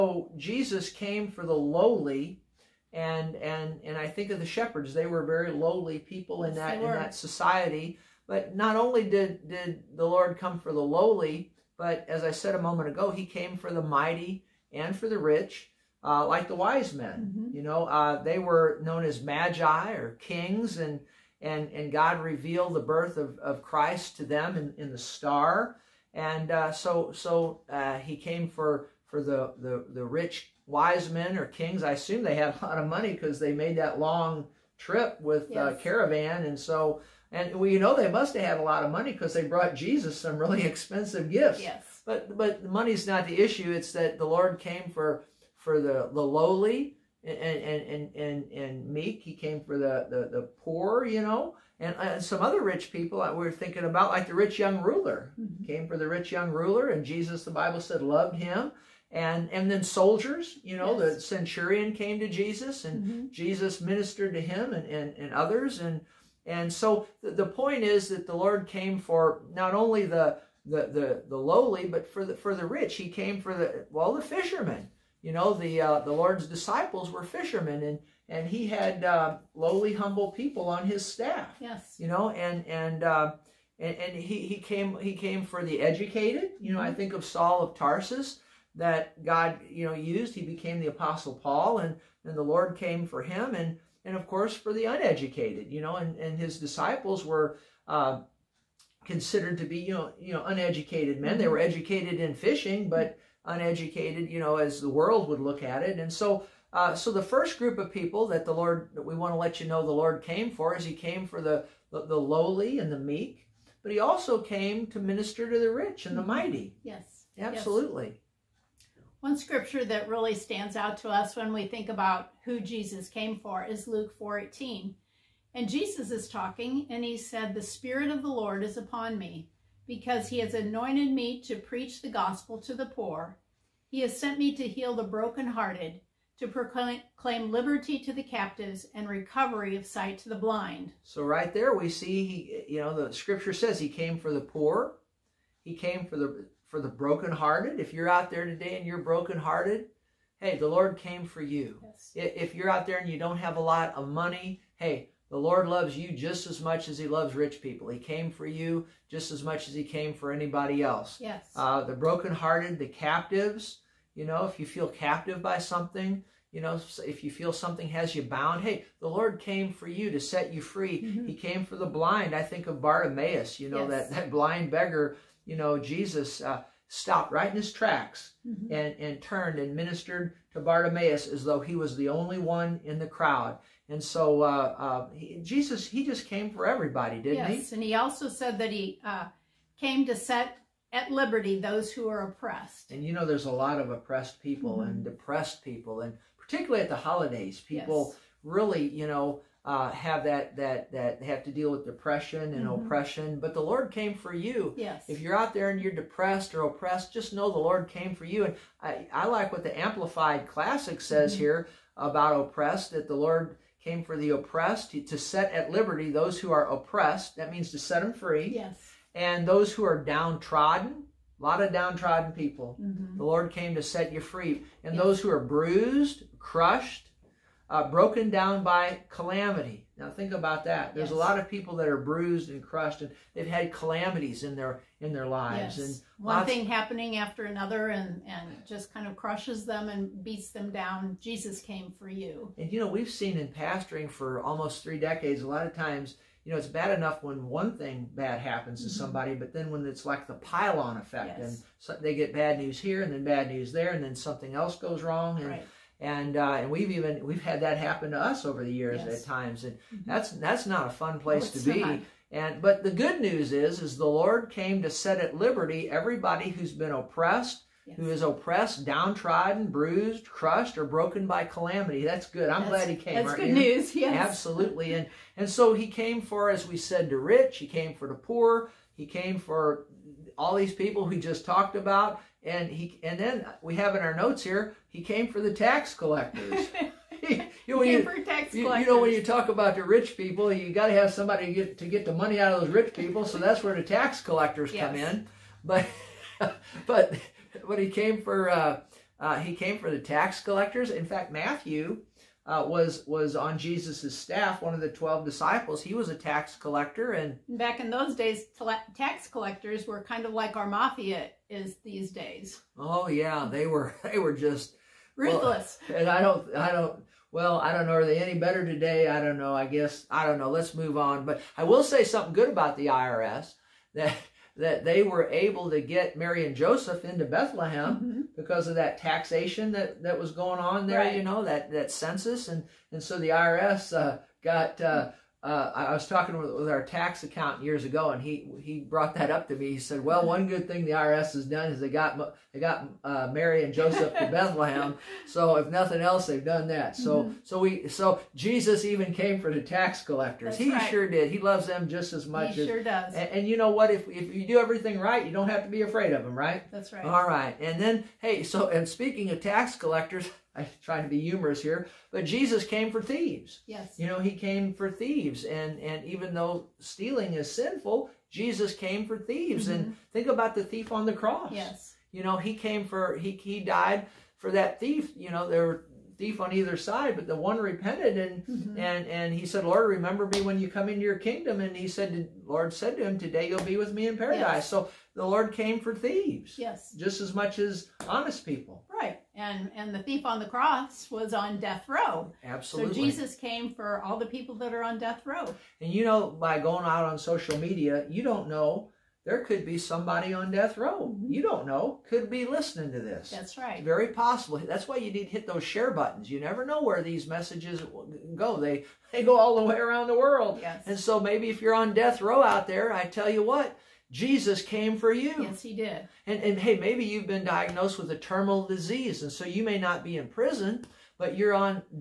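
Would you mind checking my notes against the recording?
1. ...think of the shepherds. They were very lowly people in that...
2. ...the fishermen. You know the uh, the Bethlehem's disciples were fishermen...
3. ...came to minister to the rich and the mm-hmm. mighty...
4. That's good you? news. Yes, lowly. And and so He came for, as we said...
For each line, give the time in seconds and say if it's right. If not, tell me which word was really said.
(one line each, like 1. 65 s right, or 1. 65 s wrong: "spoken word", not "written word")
1. 4 s right
2. 74 s wrong: "Lord", not "Bethlehem"
3. 114 s right
4. 273 s wrong: "absolutely", not "lowly".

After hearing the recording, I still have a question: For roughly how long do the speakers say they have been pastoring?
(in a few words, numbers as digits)
Almost three decades.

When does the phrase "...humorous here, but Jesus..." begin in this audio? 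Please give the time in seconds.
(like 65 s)
361 s.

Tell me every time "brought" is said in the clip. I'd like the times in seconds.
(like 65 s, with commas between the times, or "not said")
39 s, 338 s.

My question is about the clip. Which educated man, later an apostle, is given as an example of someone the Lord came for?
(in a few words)
Saul of Tarsus.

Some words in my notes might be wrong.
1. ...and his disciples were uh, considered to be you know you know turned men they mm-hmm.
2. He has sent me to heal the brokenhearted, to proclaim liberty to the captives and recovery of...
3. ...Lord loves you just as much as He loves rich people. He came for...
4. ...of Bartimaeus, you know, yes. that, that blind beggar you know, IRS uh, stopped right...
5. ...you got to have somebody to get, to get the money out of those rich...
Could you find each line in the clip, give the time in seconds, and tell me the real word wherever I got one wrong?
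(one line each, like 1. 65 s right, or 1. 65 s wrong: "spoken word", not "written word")
1. 96 s wrong: "uneducated", not "turned"
2. 133 s right
3. 155 s right
4. 172 s wrong: "Jesus", not "IRS"
5. 290 s right.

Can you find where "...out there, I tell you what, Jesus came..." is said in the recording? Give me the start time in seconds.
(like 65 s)
412 s.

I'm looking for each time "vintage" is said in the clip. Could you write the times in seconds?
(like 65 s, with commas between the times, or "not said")
not said.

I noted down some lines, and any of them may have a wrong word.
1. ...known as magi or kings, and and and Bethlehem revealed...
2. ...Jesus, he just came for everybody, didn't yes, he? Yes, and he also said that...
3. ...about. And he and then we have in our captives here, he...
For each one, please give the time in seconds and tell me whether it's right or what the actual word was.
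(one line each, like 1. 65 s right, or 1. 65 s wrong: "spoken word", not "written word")
1. 18 s wrong: "God", not "Bethlehem"
2. 185 s right
3. 281 s wrong: "notes", not "captives".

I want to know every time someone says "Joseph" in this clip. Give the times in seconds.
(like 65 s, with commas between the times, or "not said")
326 s, 343 s.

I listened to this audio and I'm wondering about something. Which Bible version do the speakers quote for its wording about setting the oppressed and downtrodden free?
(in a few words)
Amplified Classic.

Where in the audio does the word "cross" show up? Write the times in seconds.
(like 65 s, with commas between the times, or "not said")
371 s, 390 s.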